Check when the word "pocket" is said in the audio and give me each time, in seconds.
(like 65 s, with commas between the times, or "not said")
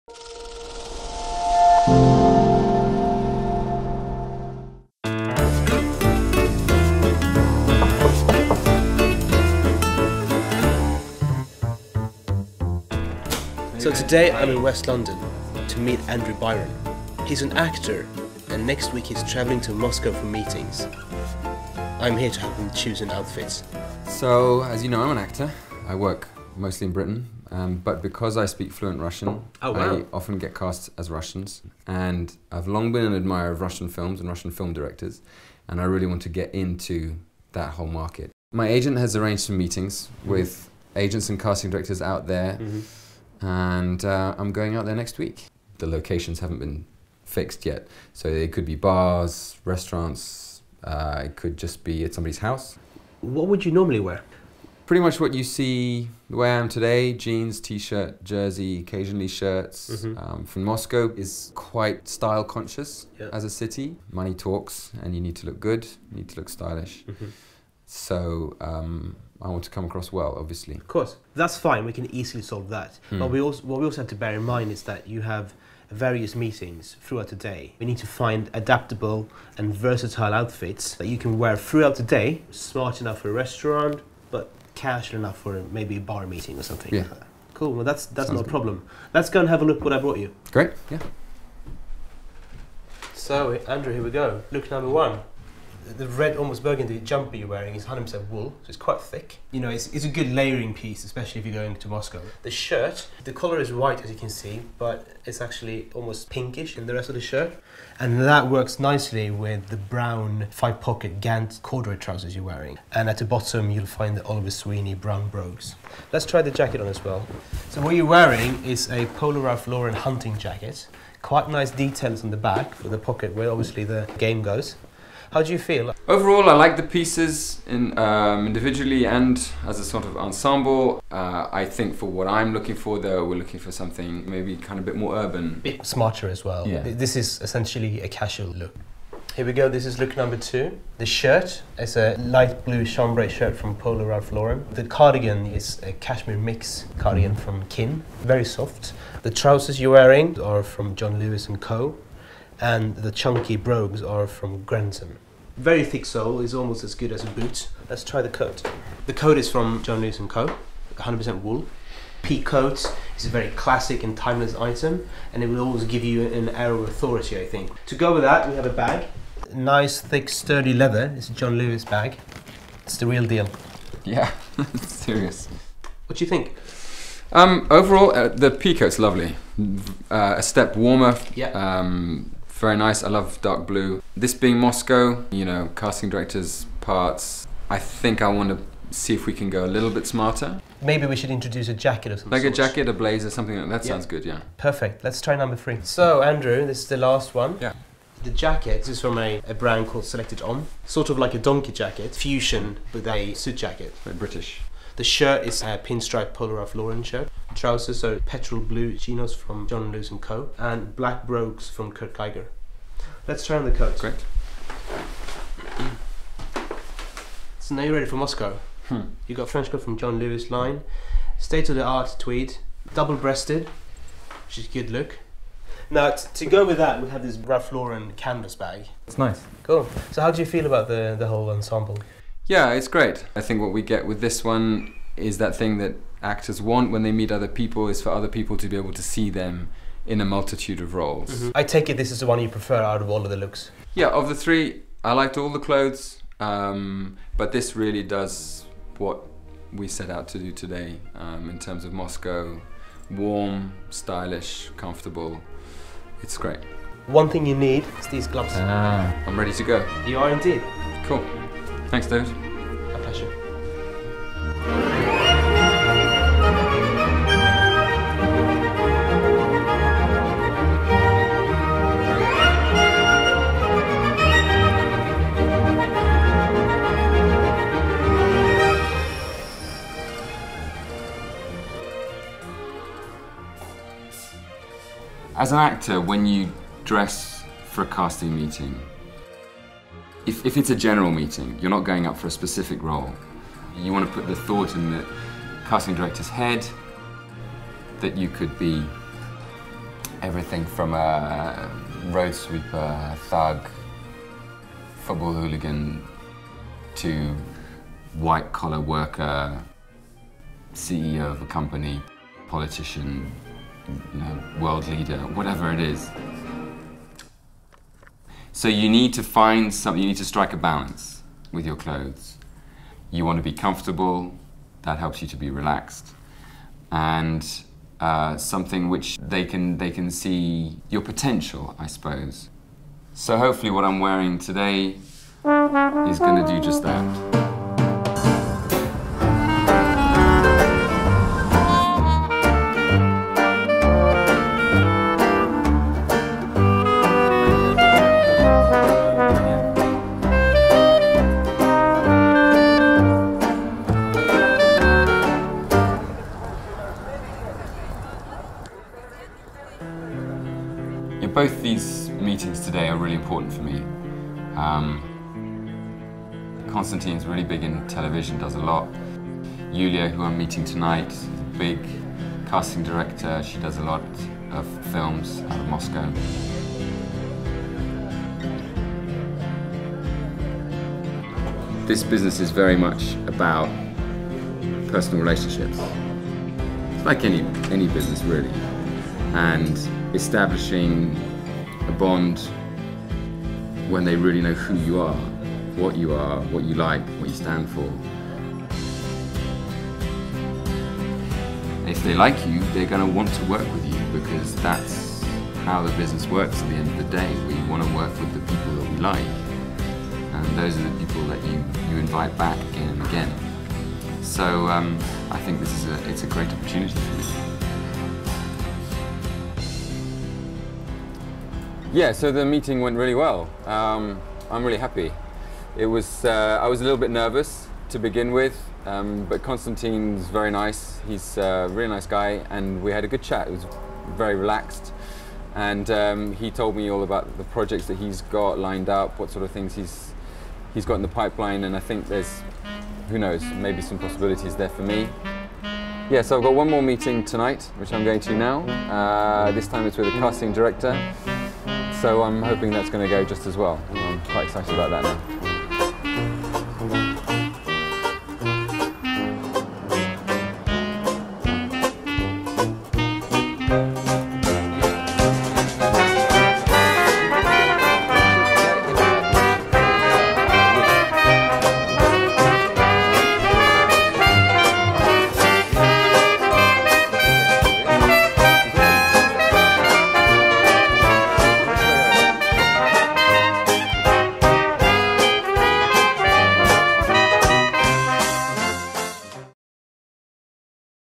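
110 s, 122 s.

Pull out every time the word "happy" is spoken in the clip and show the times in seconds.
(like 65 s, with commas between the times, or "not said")
424 s.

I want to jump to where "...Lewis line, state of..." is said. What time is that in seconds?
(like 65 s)
220 s.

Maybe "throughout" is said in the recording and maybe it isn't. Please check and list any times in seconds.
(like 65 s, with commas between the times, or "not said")
77 s, 81 s.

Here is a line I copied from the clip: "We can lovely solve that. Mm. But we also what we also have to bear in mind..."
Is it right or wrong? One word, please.
wrong.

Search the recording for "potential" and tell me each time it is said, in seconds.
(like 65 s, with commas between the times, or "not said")
331 s.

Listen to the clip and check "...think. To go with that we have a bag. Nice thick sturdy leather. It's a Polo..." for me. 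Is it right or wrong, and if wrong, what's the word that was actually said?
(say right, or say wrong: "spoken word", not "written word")
wrong: "John", not "Polo".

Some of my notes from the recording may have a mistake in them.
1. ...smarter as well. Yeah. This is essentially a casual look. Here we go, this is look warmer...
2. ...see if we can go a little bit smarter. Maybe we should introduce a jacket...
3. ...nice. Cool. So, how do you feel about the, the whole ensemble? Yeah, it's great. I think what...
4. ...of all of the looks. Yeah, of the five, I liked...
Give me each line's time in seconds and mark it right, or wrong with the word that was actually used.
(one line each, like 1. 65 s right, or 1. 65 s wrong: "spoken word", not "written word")
1. 135 s wrong: "number", not "warmer"
2. 188 s right
3. 229 s right
4. 243 s wrong: "three", not "five".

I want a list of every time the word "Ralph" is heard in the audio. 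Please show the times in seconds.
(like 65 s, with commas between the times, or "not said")
119 s, 144 s, 206 s, 227 s.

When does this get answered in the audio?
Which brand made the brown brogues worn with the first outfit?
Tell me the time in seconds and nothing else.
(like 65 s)
114 s.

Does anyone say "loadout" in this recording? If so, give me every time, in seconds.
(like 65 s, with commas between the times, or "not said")
not said.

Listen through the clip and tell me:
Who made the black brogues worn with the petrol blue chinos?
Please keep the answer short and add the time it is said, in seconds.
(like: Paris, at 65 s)
Kurt Geiger, at 211 s.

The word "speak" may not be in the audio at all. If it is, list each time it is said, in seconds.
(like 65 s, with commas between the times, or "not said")
28 s.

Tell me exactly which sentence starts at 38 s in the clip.
My agent has arranged some meetings mm-hmm.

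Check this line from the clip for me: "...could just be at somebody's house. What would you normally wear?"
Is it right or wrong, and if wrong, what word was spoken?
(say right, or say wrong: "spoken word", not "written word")
right.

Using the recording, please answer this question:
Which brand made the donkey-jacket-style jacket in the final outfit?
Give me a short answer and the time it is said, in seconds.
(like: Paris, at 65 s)
Selected Homme, at 200 s.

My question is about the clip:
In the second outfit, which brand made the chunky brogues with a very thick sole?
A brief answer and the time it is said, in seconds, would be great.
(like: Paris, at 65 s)
Grenson, at 154 s.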